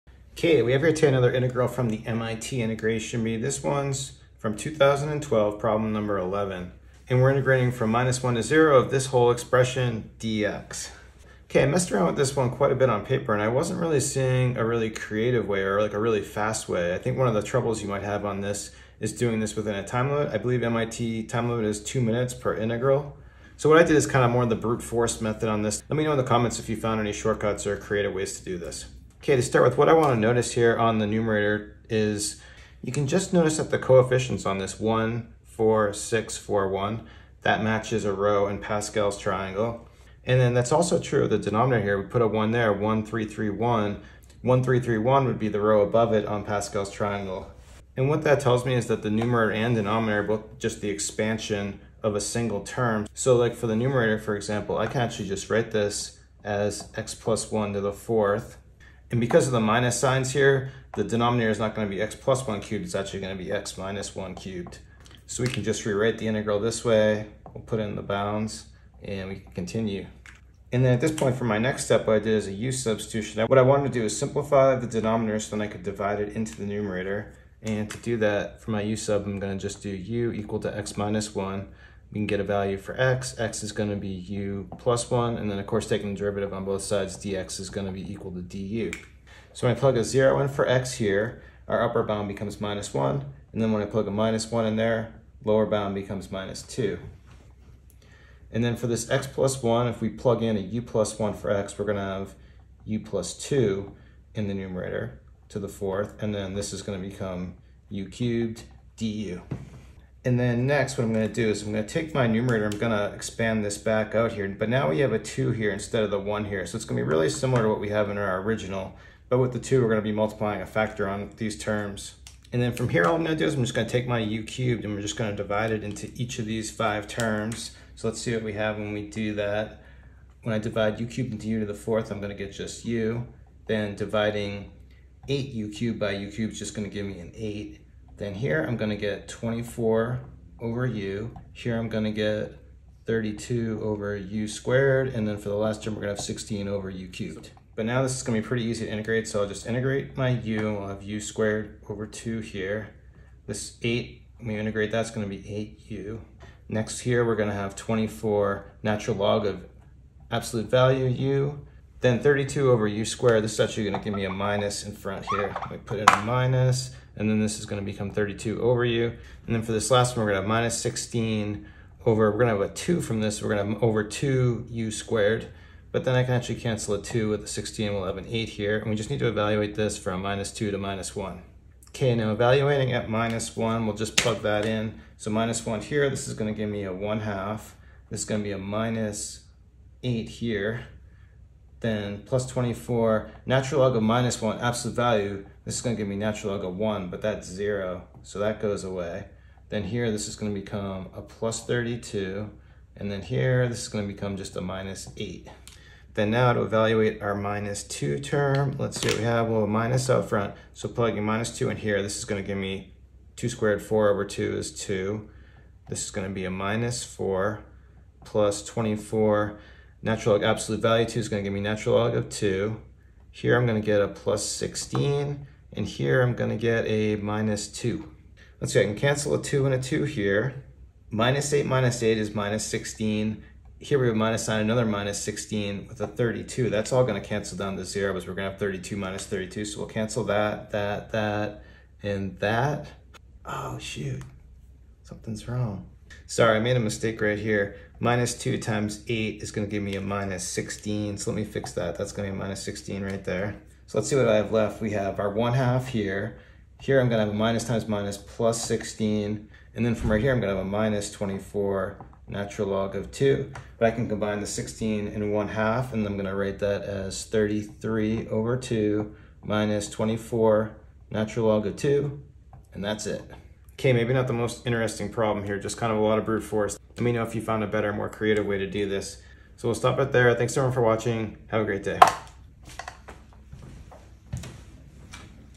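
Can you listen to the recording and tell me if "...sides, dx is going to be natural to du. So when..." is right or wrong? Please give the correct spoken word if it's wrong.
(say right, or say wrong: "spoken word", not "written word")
wrong: "equal", not "natural".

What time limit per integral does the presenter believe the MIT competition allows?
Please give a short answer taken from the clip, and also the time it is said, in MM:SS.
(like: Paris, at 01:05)
two minutes, at 00:21.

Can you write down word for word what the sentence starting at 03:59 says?
So we'll cancel that, that, that, and that.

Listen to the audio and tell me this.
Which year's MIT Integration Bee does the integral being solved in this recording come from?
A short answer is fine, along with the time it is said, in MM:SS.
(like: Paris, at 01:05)
2012, at 00:04.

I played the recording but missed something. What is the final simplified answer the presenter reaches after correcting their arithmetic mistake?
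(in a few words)
33/2 - 24 ln 2.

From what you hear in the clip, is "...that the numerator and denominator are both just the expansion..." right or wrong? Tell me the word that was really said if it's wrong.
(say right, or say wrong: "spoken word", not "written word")
right.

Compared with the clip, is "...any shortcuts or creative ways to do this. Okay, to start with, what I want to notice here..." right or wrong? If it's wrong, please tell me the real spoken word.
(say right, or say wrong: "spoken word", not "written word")
right.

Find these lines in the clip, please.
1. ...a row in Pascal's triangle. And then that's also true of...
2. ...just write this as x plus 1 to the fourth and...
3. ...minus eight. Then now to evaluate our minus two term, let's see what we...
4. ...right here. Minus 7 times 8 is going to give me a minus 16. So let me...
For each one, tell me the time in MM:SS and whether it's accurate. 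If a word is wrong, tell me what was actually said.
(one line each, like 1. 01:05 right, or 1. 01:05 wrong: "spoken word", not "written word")
1. 00:38 right
2. 00:55 right
3. 03:24 right
4. 04:07 wrong: "2", not "7".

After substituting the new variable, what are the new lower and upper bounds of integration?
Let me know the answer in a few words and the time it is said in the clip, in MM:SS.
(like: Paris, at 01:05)
-2 and -1, at 01:35.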